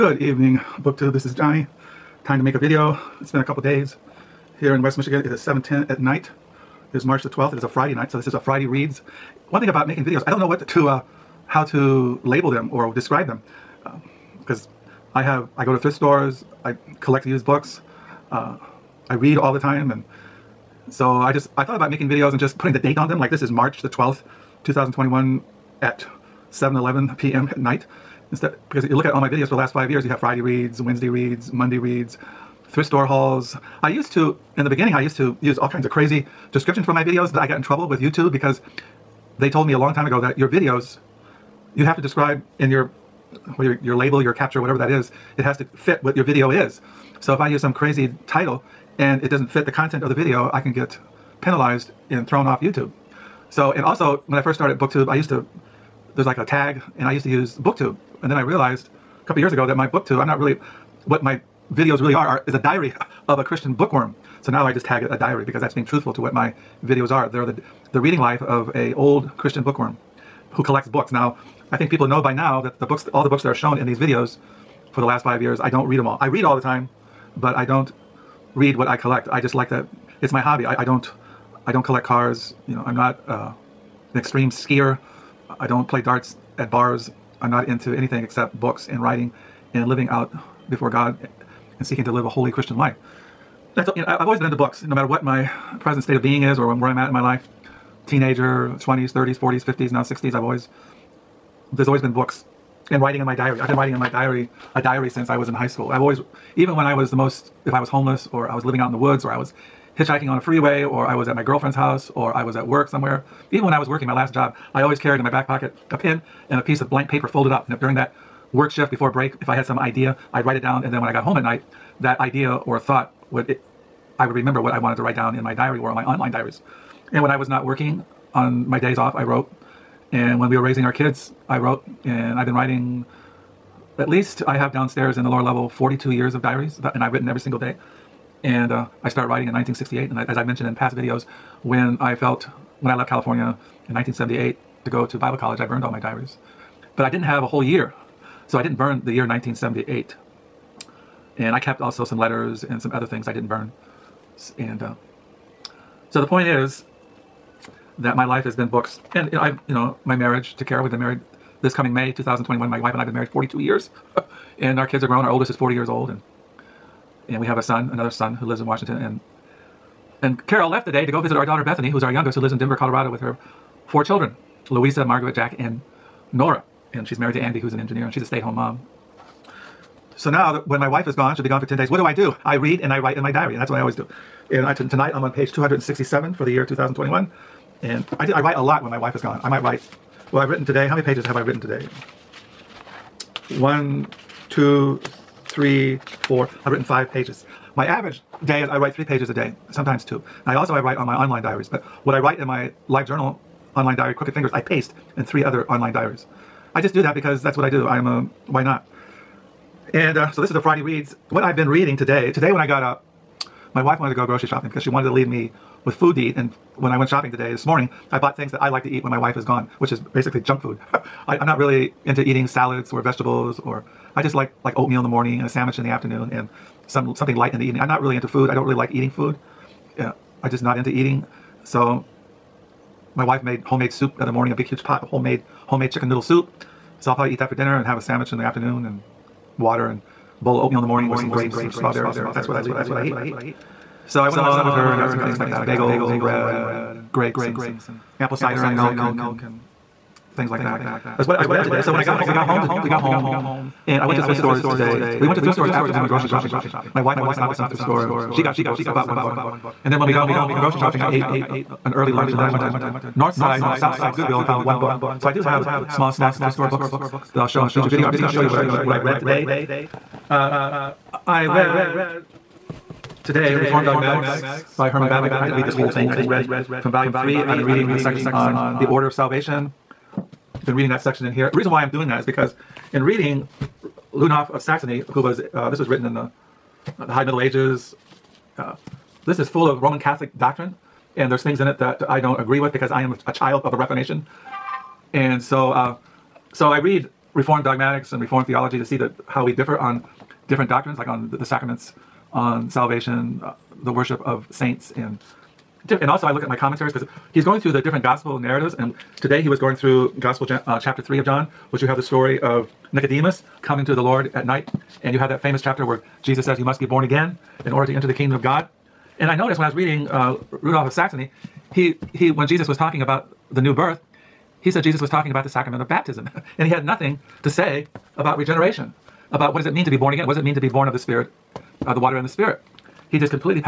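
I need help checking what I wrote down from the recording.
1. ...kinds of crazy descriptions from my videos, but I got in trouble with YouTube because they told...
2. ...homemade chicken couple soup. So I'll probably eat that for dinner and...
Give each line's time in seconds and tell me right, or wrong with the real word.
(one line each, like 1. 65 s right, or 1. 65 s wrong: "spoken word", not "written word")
1. 35 s right
2. 235 s wrong: "noodle", not "couple".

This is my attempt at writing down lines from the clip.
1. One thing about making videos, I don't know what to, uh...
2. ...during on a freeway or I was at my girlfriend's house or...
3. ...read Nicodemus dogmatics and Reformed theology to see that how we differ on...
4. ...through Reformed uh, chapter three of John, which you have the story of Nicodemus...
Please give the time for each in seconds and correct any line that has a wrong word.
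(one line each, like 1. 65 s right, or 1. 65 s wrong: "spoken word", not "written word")
1. 9 s right
2. 109 s wrong: "hitchhiking", not "during"
3. 296 s wrong: "Reformed", not "Nicodemus"
4. 309 s wrong: "Gospel", not "Reformed".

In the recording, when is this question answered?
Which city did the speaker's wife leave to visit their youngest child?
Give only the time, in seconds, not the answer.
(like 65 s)
172 s.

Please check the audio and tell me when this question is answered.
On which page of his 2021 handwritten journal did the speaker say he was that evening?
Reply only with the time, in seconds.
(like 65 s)
185 s.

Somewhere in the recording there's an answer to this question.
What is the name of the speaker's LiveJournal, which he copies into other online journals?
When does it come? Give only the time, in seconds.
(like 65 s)
204 s.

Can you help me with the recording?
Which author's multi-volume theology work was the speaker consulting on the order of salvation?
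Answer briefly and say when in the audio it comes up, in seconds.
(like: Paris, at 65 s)
Herman Bavinck, at 274 s.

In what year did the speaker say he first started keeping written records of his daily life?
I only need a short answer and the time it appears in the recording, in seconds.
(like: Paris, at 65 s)
1968, at 139 s.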